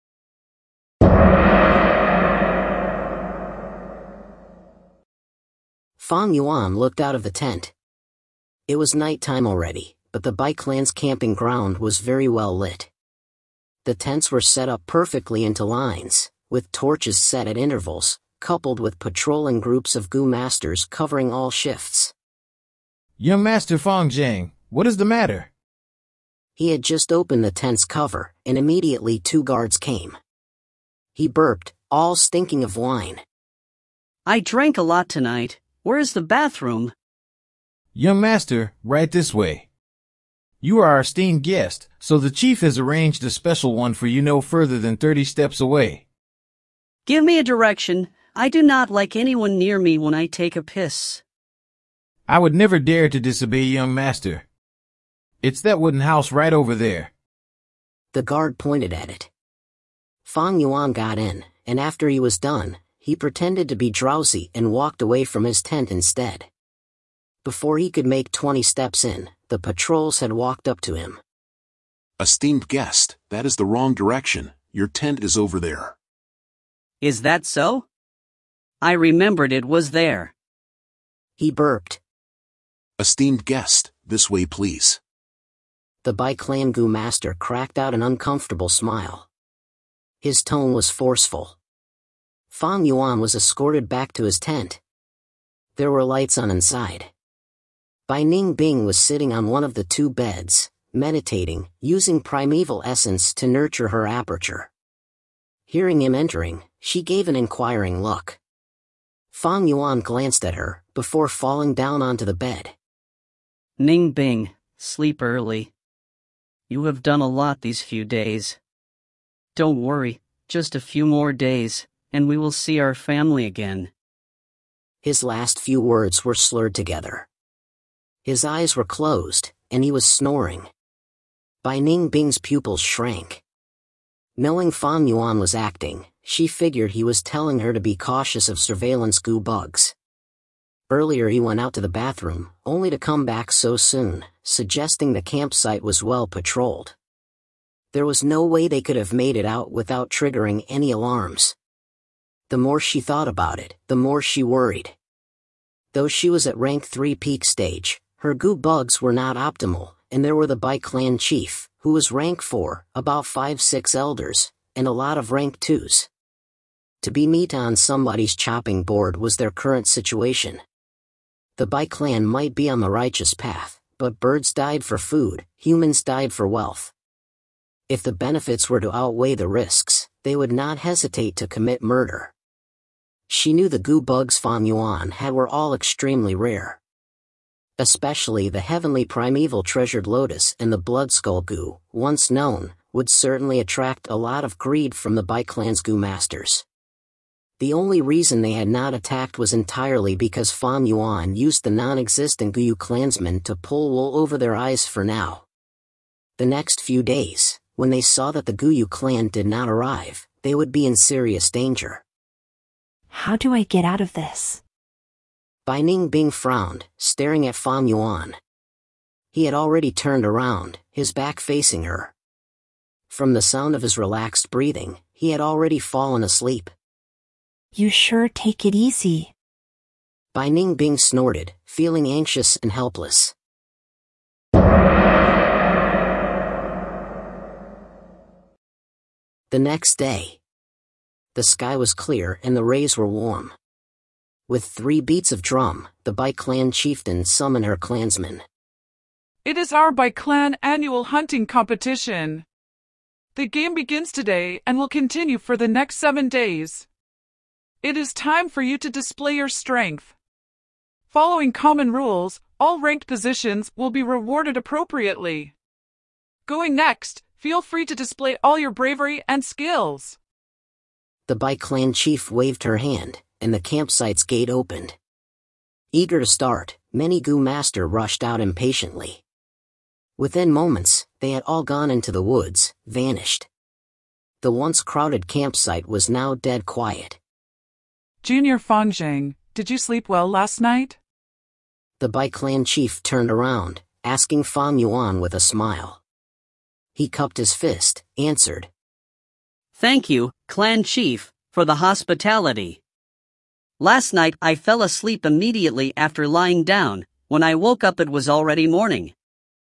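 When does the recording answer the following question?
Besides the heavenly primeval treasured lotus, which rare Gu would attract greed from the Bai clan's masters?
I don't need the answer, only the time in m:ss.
3:10.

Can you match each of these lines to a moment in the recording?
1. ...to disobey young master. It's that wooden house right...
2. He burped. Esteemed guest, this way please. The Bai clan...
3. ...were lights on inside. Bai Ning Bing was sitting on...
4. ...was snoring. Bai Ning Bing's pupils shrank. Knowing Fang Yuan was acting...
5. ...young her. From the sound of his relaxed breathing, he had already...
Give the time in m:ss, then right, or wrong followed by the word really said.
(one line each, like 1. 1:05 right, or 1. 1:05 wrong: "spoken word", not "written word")
1. 0:53 right
2. 1:21 right
3. 1:35 right
4. 2:09 right
5. 3:41 wrong: "facing", not "young".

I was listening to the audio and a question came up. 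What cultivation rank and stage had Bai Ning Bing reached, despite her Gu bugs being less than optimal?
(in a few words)
Rank 3 peak stage.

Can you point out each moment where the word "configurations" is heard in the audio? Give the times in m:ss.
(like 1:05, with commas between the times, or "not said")
not said.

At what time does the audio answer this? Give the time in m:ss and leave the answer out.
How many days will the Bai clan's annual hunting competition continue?
4:15.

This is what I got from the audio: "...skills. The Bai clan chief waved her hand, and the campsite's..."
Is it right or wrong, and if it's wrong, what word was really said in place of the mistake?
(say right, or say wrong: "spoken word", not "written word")
right.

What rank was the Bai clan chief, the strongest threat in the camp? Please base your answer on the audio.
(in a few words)
Rank 4.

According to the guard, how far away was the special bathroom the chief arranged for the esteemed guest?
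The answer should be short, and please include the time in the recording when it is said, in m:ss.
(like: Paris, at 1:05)
30 steps, at 0:44.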